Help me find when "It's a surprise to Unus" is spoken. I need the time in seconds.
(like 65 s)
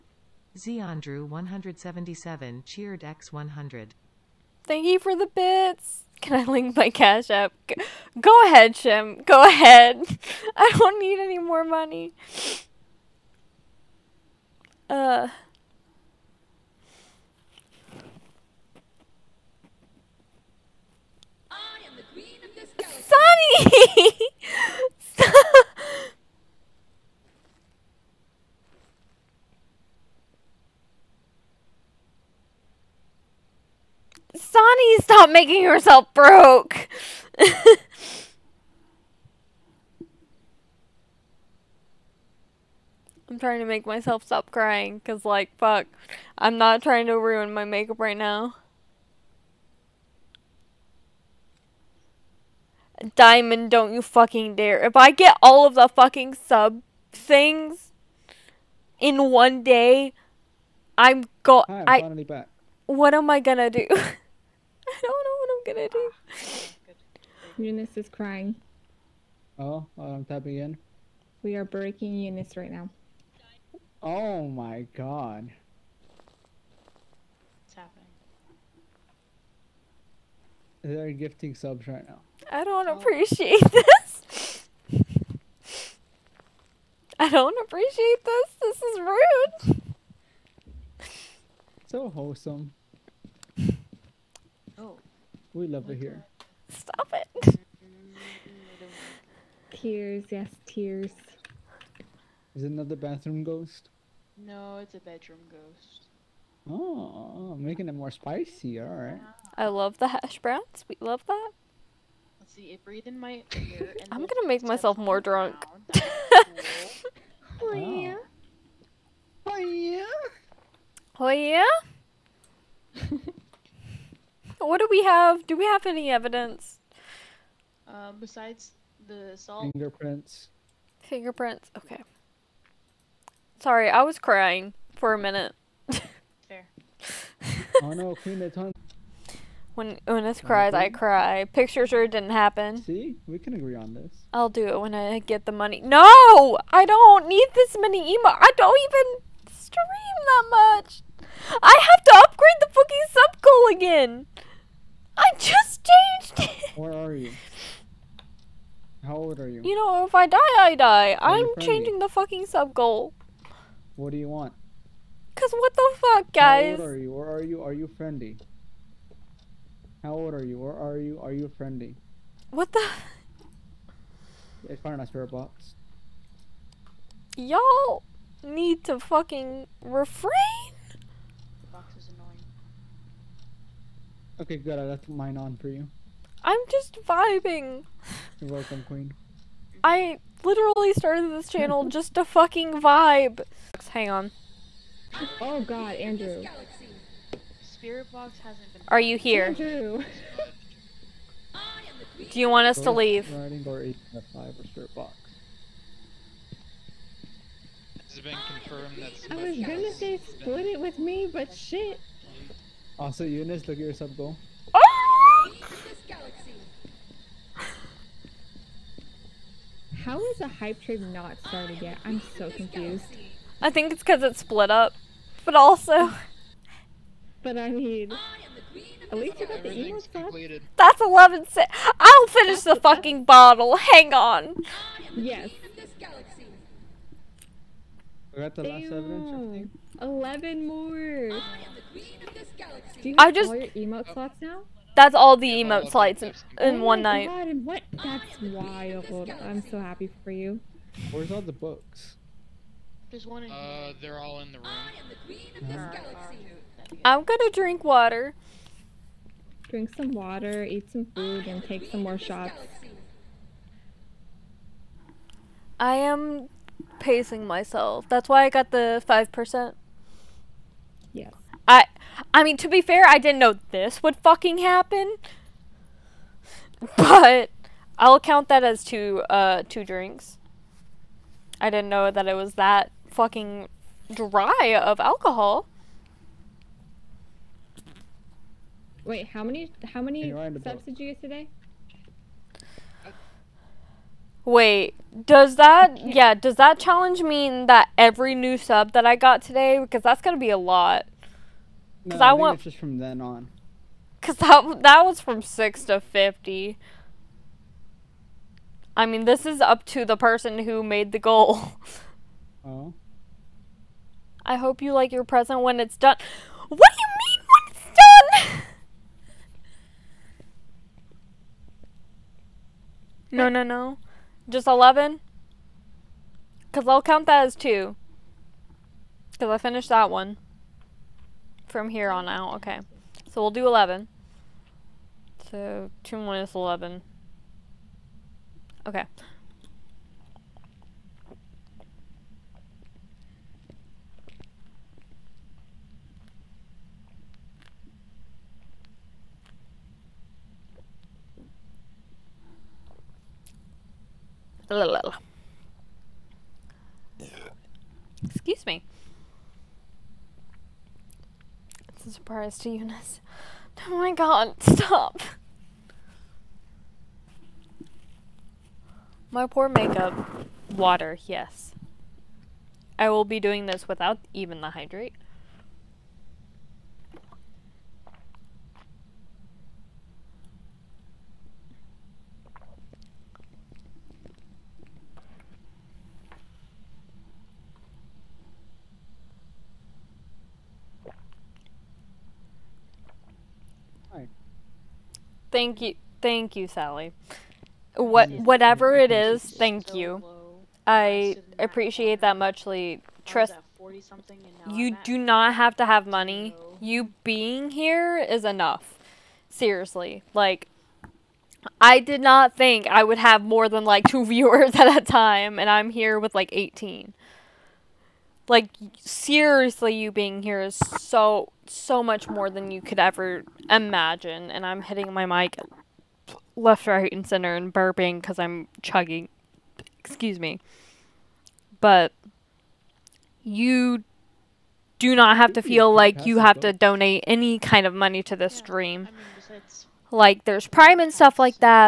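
361 s.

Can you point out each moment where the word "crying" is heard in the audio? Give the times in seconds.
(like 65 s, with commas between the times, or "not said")
44 s, 68 s, 134 s.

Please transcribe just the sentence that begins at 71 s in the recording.
We are breaking Unus right now.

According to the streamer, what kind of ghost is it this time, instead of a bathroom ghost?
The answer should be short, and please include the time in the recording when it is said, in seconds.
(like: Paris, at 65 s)
Bedroom ghost, at 105 s.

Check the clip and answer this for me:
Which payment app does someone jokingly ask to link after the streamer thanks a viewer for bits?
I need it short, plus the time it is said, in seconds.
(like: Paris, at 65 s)
Cash App, at 6 s.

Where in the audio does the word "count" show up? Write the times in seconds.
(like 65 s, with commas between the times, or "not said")
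278 s, 327 s.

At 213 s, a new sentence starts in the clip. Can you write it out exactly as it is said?
Also, Unus, look at your sub goal.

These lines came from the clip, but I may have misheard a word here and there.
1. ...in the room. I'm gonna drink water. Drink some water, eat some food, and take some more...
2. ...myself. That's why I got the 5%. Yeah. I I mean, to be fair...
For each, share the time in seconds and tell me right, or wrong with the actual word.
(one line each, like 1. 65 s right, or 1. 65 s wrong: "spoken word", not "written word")
1. 254 s right
2. 267 s right.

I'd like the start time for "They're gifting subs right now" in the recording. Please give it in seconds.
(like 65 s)
80 s.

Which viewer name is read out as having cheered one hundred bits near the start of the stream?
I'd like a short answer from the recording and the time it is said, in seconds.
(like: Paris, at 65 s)
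Andrew 177, at 1 s.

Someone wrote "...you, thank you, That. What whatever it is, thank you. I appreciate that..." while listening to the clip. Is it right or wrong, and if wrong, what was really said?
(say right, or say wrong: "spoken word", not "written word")
wrong: "Sally", not "That".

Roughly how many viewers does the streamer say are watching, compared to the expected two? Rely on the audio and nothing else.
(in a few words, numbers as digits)
18.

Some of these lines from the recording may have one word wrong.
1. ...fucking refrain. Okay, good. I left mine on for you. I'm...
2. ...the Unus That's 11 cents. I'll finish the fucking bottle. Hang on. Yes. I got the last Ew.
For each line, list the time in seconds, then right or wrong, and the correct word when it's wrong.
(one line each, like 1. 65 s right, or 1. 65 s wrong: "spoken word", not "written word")
1. 178 s right
2. 229 s right.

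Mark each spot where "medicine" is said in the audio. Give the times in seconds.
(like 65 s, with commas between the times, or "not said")
not said.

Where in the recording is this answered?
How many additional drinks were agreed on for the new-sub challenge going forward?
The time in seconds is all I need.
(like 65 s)
333 s.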